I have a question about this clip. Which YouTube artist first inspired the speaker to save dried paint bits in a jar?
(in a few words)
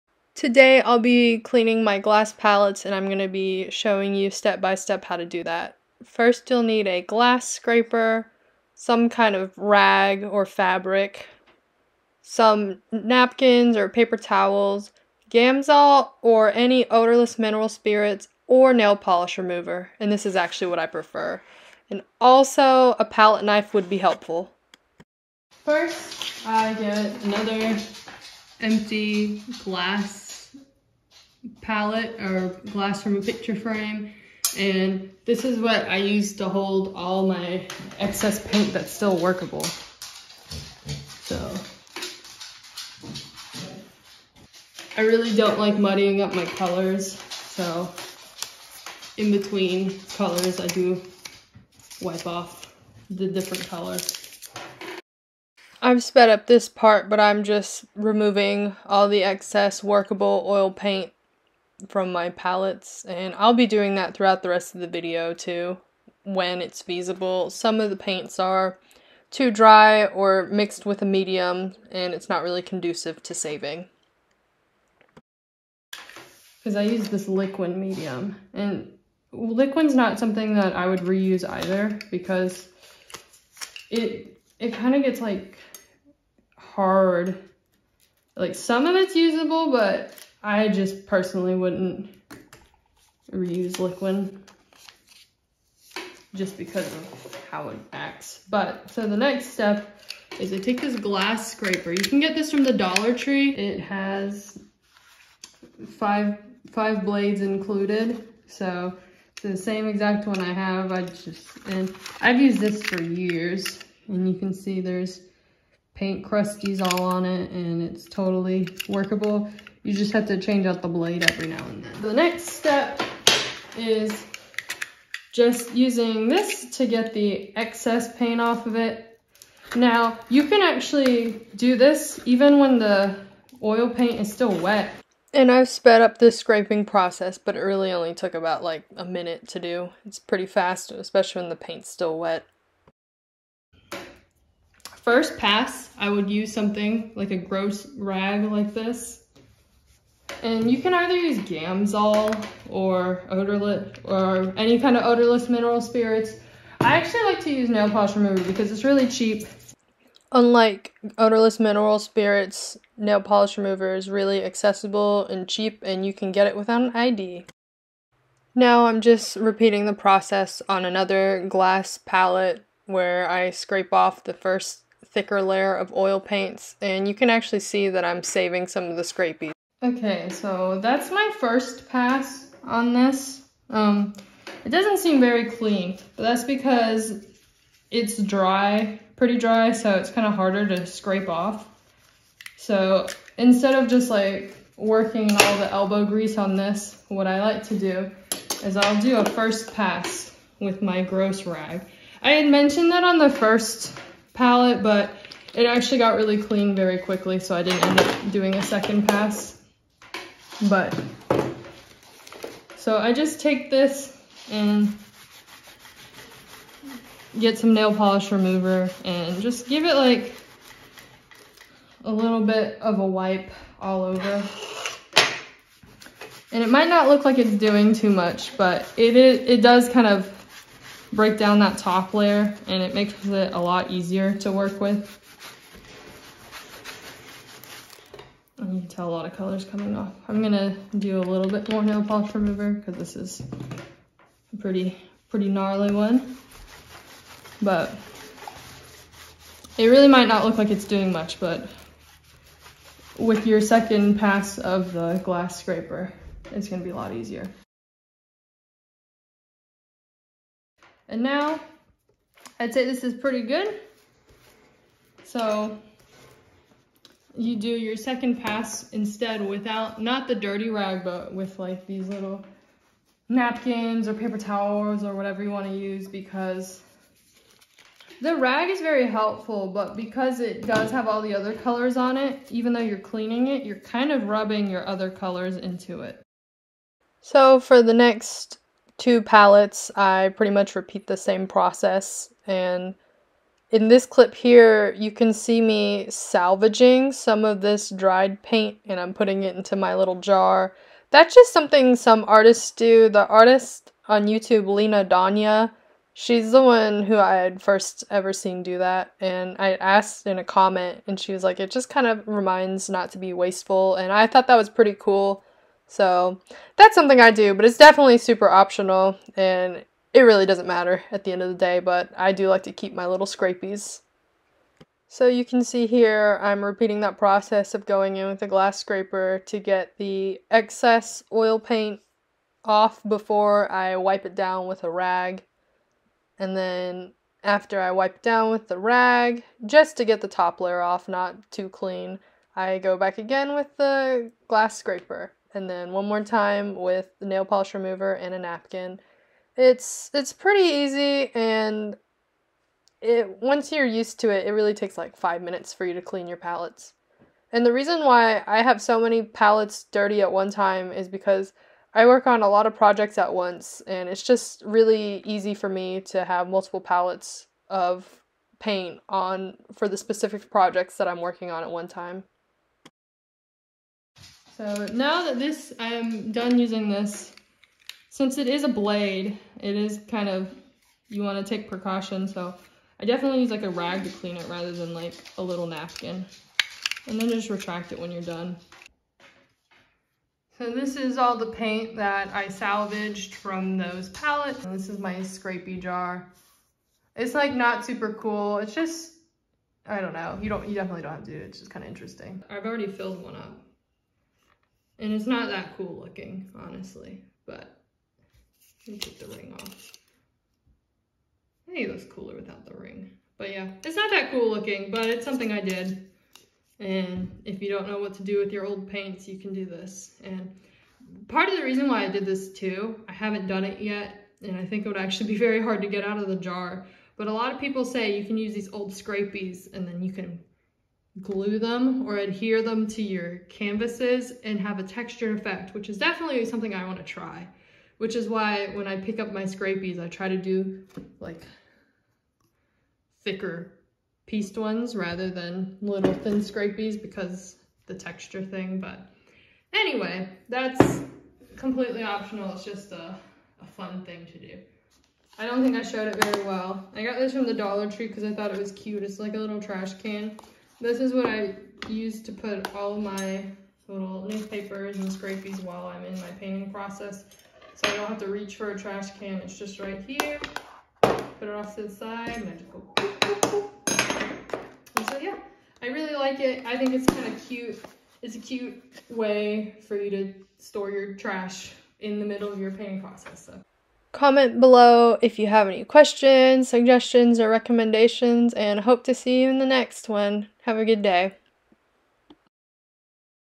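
Lena Danya.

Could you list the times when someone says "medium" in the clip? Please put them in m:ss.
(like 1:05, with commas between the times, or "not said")
1:11, 1:17.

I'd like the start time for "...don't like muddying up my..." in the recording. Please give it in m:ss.
0:45.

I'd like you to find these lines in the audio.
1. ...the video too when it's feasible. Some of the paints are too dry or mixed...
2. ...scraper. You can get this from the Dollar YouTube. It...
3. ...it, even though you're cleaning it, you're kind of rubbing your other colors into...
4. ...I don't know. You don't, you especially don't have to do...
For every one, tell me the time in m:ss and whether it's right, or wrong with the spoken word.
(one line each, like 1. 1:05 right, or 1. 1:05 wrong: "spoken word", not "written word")
1. 1:04 right
2. 1:41 wrong: "Tree", not "YouTube"
3. 4:42 right
4. 6:39 wrong: "definitely", not "especially".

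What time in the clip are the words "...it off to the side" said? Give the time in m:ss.
7:51.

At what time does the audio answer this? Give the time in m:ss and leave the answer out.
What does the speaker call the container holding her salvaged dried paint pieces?
6:35.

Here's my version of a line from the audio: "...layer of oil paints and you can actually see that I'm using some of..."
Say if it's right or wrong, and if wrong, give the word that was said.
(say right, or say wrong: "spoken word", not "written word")
wrong: "saving", not "using".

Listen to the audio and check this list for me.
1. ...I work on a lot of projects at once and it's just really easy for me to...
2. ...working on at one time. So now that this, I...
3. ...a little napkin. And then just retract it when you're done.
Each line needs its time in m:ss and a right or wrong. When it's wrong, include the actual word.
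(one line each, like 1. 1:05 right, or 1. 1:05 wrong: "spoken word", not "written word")
1. 6:01 right
2. 6:11 right
3. 6:25 right.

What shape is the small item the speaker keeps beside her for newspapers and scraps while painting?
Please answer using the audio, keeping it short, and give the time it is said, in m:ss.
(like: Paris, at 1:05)
A little trash can, at 7:39.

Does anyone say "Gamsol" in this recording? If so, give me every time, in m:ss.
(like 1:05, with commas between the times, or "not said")
0:15, 2:31.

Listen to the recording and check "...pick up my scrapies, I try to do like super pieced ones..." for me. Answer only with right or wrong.
wrong.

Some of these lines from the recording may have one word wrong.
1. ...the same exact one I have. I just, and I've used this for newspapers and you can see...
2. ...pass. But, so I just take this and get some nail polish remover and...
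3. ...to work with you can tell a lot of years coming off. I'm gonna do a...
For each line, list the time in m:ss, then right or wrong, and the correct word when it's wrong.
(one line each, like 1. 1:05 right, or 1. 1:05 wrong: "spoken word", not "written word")
1. 1:49 wrong: "years", not "newspapers"
2. 3:29 right
3. 3:54 wrong: "colors", not "years".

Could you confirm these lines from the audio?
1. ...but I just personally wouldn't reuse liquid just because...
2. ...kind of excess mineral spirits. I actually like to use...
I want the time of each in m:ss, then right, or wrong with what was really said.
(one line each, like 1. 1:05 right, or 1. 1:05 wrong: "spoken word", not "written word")
1. 1:29 right
2. 2:34 wrong: "odorless", not "excess".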